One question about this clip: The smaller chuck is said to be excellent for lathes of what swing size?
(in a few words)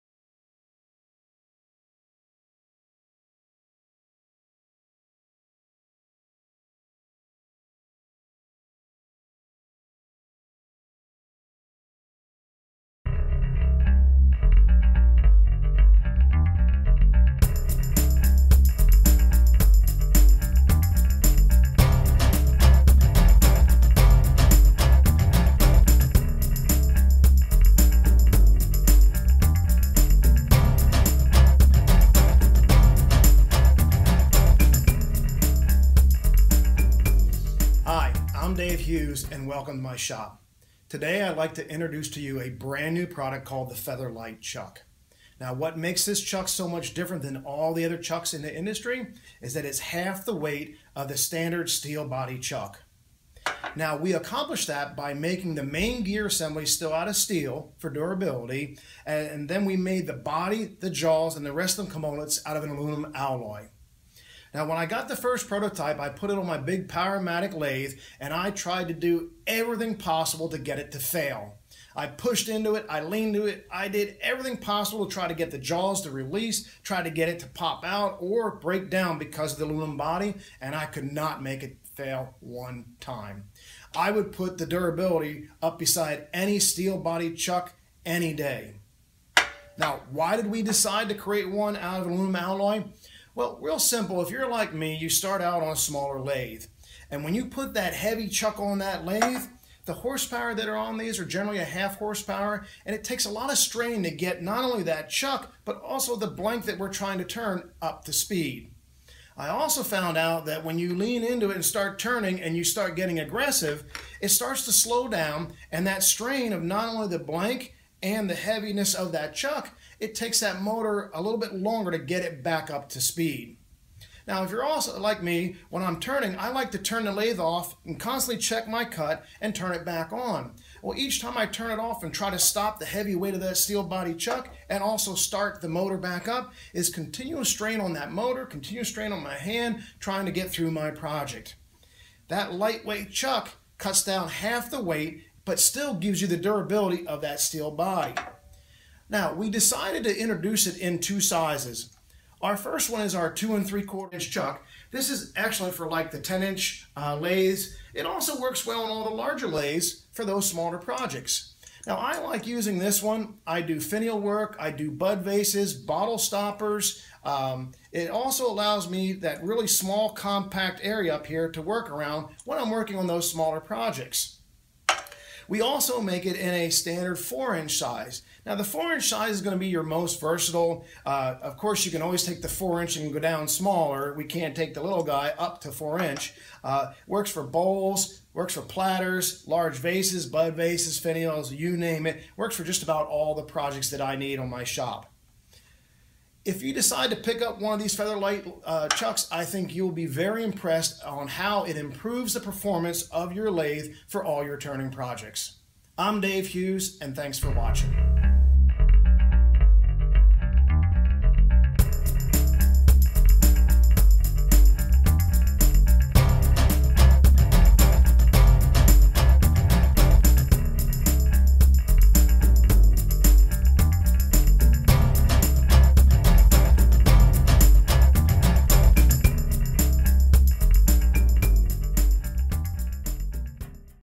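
10 inch.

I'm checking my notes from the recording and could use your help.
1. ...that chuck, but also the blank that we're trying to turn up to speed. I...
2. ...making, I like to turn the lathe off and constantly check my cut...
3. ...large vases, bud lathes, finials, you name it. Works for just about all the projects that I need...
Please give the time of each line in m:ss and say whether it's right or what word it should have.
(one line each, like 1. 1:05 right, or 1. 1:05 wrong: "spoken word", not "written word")
1. 1:44 right
2. 2:05 wrong: "turning", not "making"
3. 3:09 wrong: "vases", not "lathes".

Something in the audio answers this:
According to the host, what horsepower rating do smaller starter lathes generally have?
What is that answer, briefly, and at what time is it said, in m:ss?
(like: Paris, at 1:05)
1/2 horsepower, at 1:41.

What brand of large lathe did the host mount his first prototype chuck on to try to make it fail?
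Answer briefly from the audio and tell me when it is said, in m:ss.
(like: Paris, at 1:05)
Powermatic, at 1:06.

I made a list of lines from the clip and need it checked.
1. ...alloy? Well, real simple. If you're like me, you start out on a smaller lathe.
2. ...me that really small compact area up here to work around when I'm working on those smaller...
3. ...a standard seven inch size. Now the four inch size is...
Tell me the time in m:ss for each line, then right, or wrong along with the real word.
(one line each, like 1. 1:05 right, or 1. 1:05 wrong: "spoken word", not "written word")
1. 1:32 right
2. 2:48 right
3. 2:56 wrong: "four", not "seven".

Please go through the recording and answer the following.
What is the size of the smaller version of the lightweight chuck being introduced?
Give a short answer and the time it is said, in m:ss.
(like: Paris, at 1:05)
2 3/4 inch, at 2:33.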